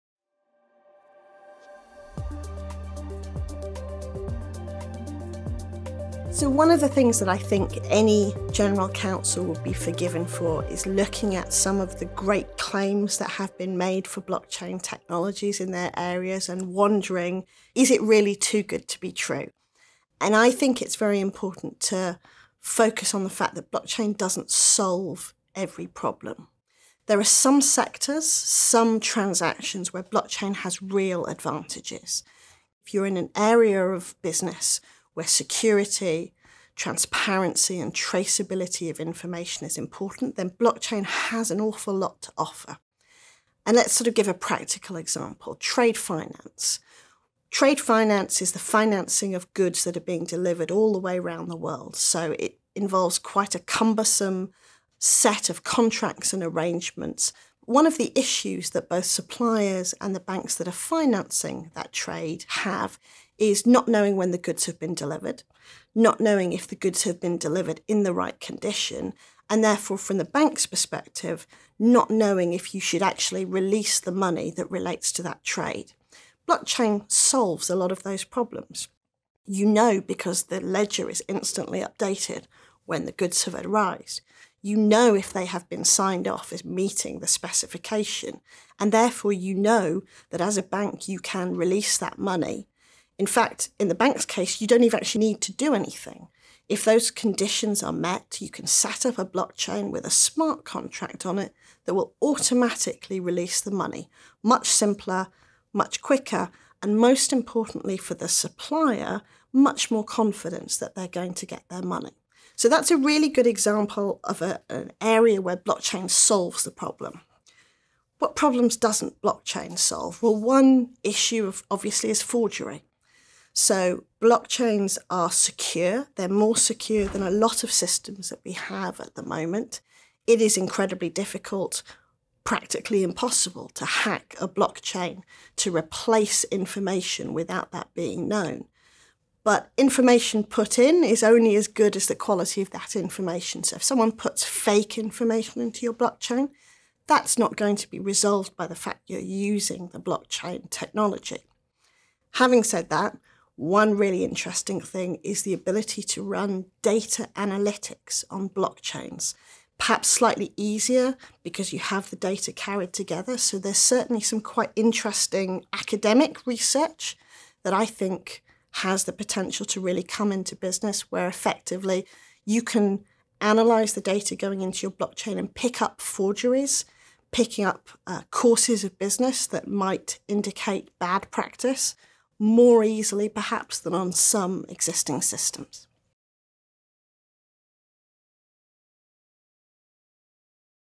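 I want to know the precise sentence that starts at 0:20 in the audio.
And I think it's very important to focus on the fact that blockchain doesn't solve every problem.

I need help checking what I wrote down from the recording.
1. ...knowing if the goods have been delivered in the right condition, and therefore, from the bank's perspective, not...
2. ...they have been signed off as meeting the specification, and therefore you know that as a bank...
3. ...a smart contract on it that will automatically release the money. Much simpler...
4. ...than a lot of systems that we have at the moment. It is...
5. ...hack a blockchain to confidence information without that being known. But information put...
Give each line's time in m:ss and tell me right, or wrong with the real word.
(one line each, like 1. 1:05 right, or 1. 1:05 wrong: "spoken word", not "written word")
1. 1:06 right
2. 1:25 right
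3. 1:40 right
4. 2:07 right
5. 2:13 wrong: "replace", not "confidence".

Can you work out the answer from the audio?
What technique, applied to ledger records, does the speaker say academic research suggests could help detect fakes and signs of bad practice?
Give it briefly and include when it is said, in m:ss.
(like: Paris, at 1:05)
Data analytics, at 2:36.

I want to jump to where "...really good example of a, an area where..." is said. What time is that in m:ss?
1:52.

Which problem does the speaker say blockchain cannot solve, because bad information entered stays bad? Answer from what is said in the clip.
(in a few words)
Forgery.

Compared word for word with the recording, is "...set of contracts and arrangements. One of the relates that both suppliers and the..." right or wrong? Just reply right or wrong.
wrong.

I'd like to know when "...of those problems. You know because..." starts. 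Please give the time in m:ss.
1:17.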